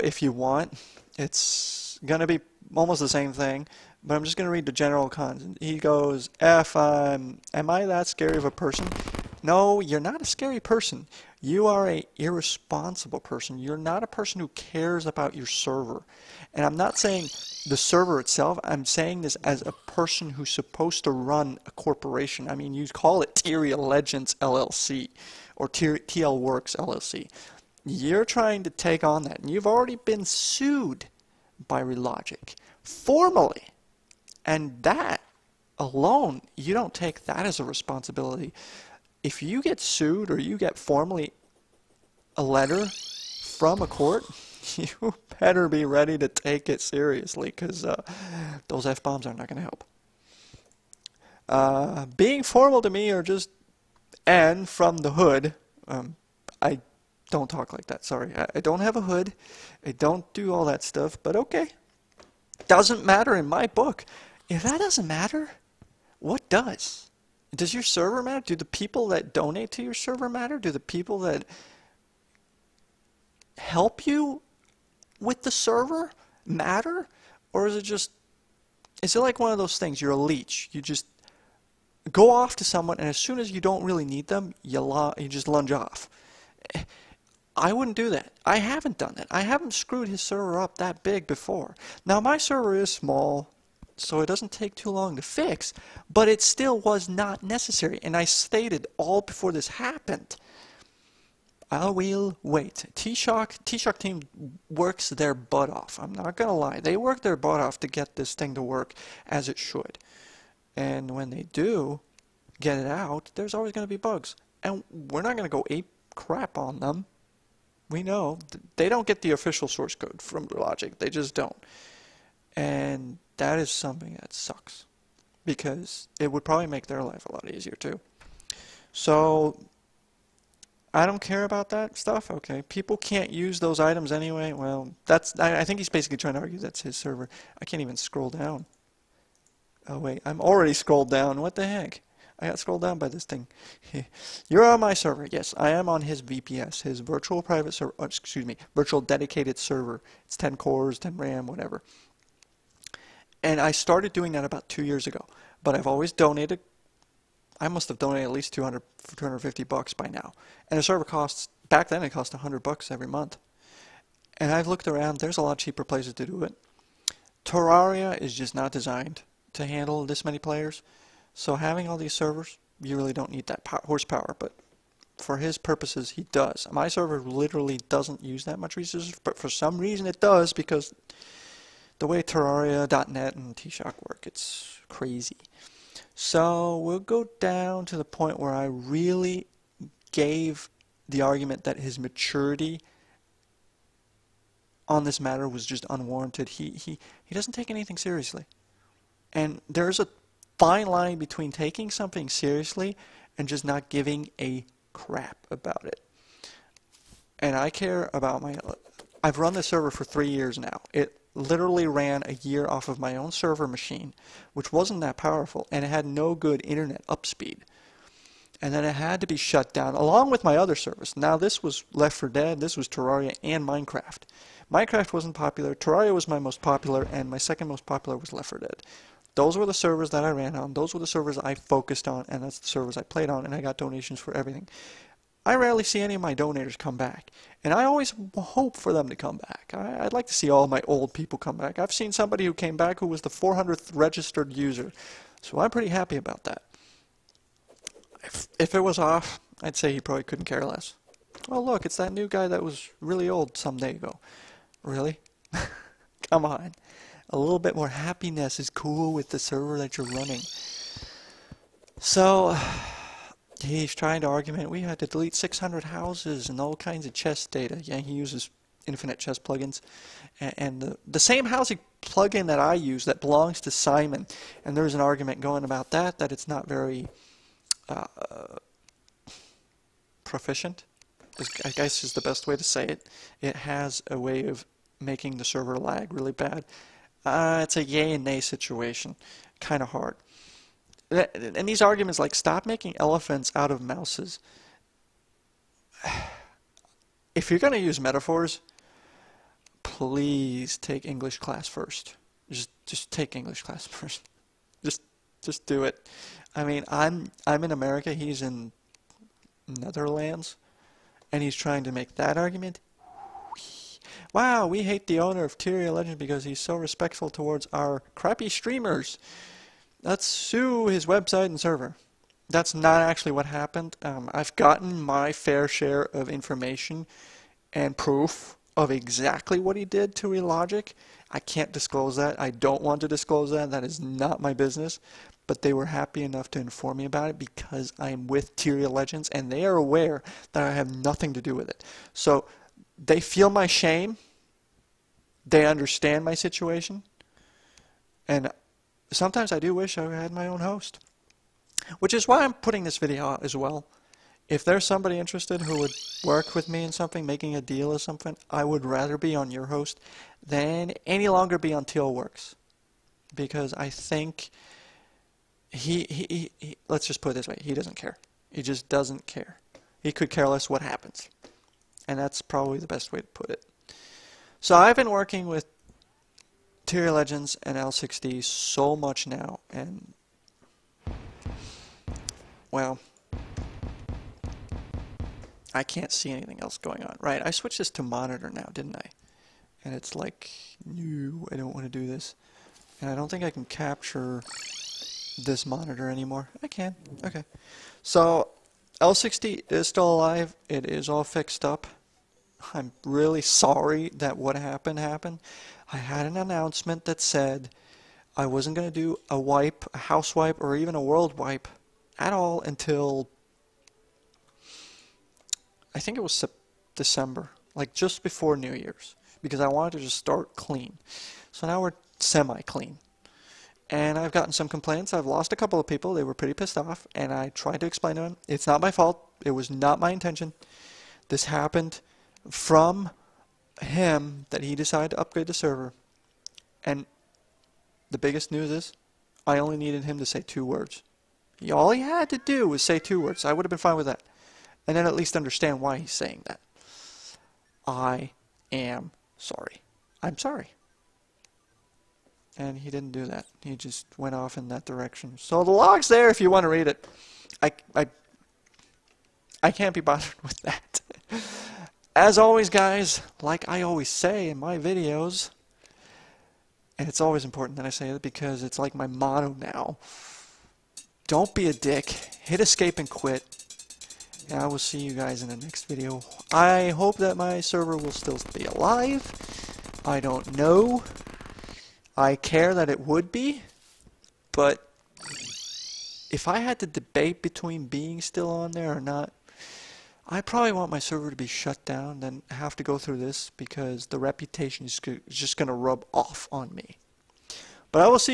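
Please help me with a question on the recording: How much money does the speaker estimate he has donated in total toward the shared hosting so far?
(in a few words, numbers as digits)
$250.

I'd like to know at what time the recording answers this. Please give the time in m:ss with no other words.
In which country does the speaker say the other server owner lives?
5:09.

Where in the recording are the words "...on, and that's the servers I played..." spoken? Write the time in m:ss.
3:52.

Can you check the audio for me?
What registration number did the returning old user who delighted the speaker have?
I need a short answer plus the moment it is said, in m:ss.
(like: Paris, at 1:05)
400th, at 4:03.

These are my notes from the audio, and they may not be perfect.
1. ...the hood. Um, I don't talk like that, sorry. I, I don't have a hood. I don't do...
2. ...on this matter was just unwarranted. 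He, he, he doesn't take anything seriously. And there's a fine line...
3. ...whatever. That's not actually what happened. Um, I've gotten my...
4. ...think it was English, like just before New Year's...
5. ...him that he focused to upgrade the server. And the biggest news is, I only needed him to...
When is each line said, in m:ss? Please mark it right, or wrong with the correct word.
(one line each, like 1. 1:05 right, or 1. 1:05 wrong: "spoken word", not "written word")
1. 0:54 right
2. 3:14 right
3. 5:21 wrong: "server", not "whatever"
4. 6:55 wrong: "December", not "English"
5. 7:13 wrong: "decided", not "focused".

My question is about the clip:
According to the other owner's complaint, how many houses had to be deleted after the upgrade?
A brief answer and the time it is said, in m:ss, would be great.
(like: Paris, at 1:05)
600, at 4:25.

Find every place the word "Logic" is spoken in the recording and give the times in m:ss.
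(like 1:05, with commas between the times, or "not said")
0:31, 2:00, 5:30.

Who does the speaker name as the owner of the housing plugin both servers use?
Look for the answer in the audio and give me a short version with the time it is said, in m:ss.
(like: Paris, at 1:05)
Simon, at 4:33.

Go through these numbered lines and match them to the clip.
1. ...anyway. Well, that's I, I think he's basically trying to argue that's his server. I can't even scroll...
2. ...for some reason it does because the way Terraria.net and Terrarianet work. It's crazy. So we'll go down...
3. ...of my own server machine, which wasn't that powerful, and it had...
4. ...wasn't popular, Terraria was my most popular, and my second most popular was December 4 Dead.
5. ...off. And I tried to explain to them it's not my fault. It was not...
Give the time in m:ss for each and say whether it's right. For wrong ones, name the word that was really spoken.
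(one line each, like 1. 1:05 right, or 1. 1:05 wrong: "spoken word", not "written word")
1. 2:14 right
2. 2:59 wrong: "TShock", not "Terrarianet"
3. 3:32 right
4. 3:45 wrong: "Left", not "December"
5. 7:06 right.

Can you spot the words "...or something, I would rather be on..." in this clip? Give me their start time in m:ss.
5:57.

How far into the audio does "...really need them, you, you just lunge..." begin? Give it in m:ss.
1:23.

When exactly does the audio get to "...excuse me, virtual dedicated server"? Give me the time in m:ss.
2:28.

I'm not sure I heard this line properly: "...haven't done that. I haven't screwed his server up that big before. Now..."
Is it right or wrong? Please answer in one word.
right.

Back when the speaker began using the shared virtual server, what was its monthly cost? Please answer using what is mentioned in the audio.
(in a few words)
$100.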